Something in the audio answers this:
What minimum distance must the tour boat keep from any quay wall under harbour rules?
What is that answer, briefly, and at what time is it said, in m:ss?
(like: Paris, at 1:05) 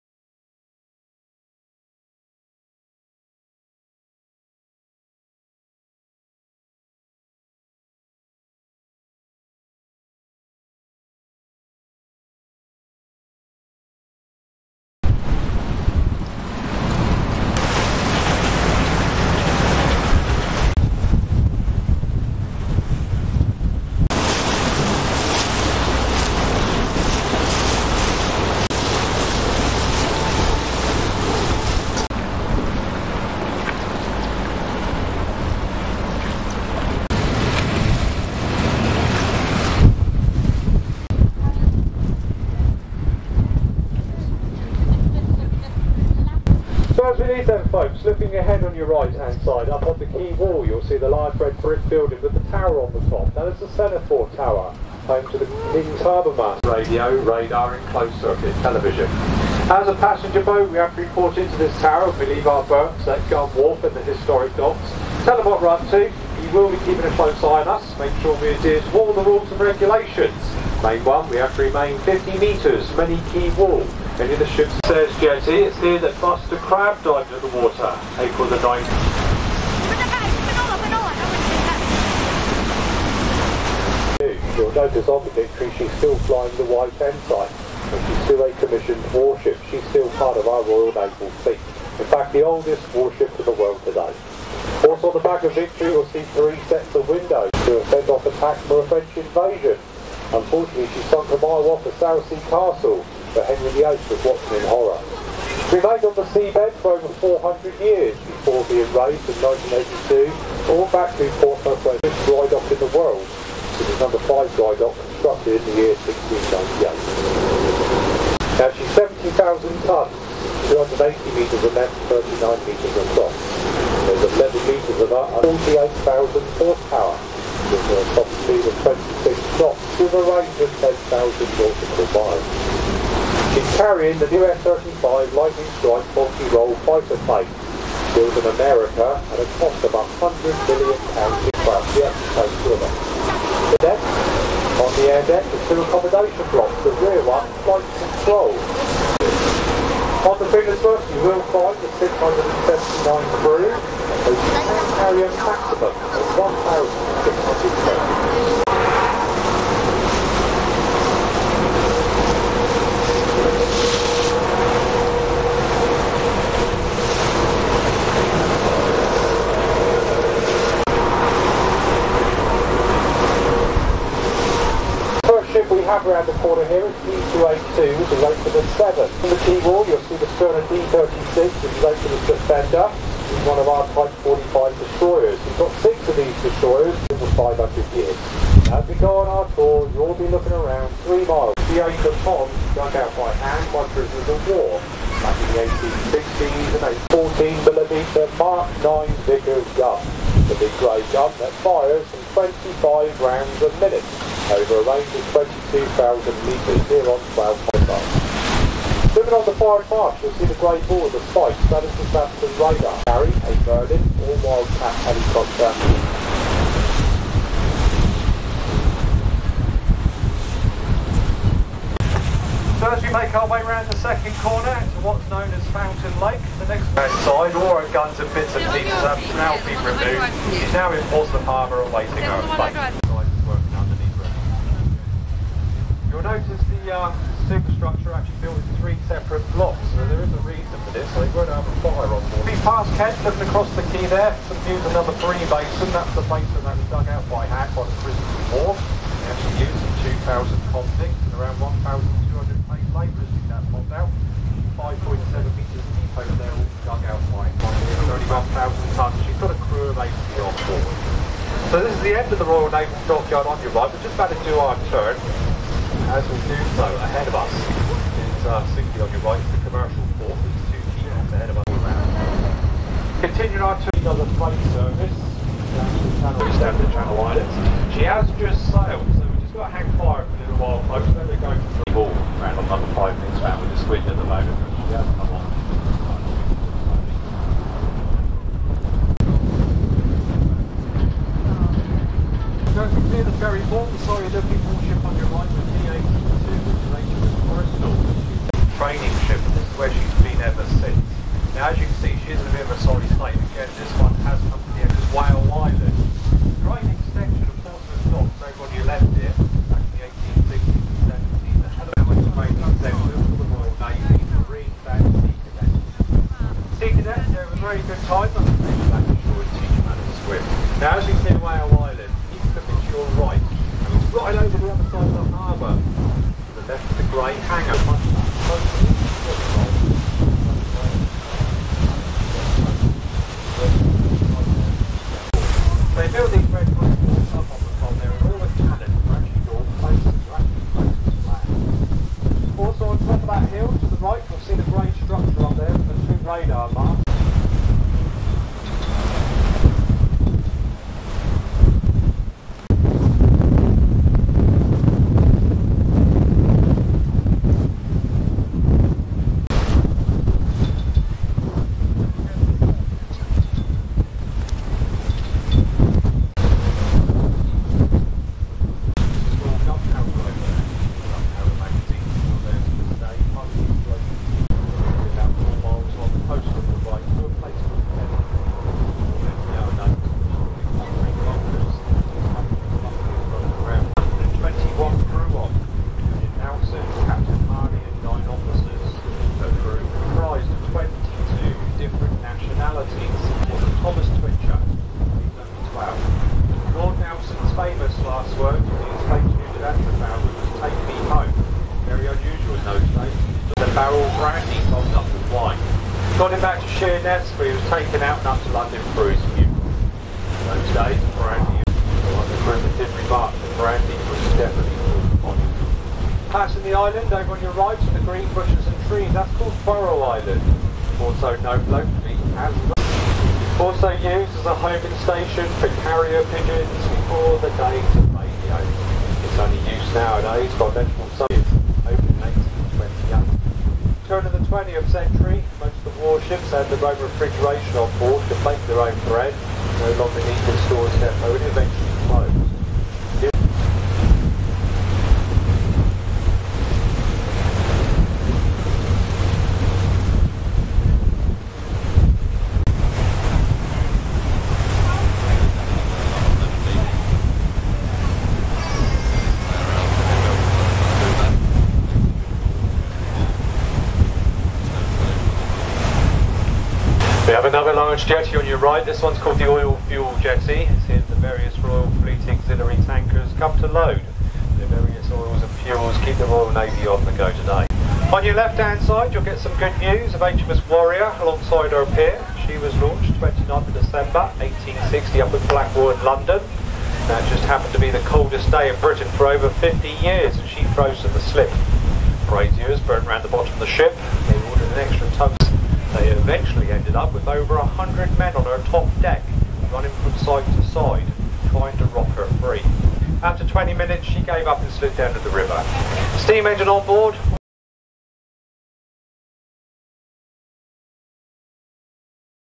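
50 metres, at 1:11.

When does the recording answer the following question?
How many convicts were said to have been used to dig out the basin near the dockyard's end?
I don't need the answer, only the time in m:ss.
4:10.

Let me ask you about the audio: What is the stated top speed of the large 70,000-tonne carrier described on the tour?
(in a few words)
26 knots.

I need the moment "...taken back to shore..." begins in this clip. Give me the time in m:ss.
5:19.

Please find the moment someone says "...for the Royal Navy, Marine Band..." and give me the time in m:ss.
5:13.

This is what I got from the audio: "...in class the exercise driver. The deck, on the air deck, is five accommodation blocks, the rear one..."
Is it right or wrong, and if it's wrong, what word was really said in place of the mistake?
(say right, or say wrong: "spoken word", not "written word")
wrong: "two", not "five".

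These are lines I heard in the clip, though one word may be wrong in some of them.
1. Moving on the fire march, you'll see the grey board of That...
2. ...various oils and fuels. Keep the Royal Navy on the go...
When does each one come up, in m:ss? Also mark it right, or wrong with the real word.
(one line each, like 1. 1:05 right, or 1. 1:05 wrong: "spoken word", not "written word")
1. 3:29 right
2. 7:54 right.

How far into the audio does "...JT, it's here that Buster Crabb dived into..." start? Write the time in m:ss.
1:15.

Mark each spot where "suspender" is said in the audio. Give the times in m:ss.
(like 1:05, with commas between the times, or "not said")
3:02.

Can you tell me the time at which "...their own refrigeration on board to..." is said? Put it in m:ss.
7:16.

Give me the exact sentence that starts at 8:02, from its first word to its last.
She was launched 29th of December 1860 up at Blackwall, London.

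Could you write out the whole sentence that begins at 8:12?
Braziers burnt around the bottom of the ship.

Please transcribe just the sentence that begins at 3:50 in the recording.
It's now in Portsmouth Harbour awaiting our flight.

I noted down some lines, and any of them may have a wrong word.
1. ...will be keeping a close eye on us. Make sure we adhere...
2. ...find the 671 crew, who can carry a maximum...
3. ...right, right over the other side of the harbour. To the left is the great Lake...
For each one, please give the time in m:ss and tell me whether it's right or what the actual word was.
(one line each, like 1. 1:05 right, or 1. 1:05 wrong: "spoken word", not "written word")
1. 1:06 right
2. 2:31 wrong: "679", not "671"
3. 5:23 wrong: "Hangar", not "Lake".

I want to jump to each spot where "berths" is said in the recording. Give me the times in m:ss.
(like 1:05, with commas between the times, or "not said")
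1:02.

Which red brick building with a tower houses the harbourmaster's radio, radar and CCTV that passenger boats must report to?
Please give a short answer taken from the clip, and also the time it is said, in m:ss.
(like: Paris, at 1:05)
Semaphore Tower, at 0:53.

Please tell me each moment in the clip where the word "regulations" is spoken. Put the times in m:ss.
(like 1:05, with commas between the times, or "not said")
1:09.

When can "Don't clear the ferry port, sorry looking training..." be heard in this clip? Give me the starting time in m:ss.
4:52.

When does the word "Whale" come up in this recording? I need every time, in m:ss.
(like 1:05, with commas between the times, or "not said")
5:05, 5:21.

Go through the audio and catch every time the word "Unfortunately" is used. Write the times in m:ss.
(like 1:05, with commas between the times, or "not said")
1:40.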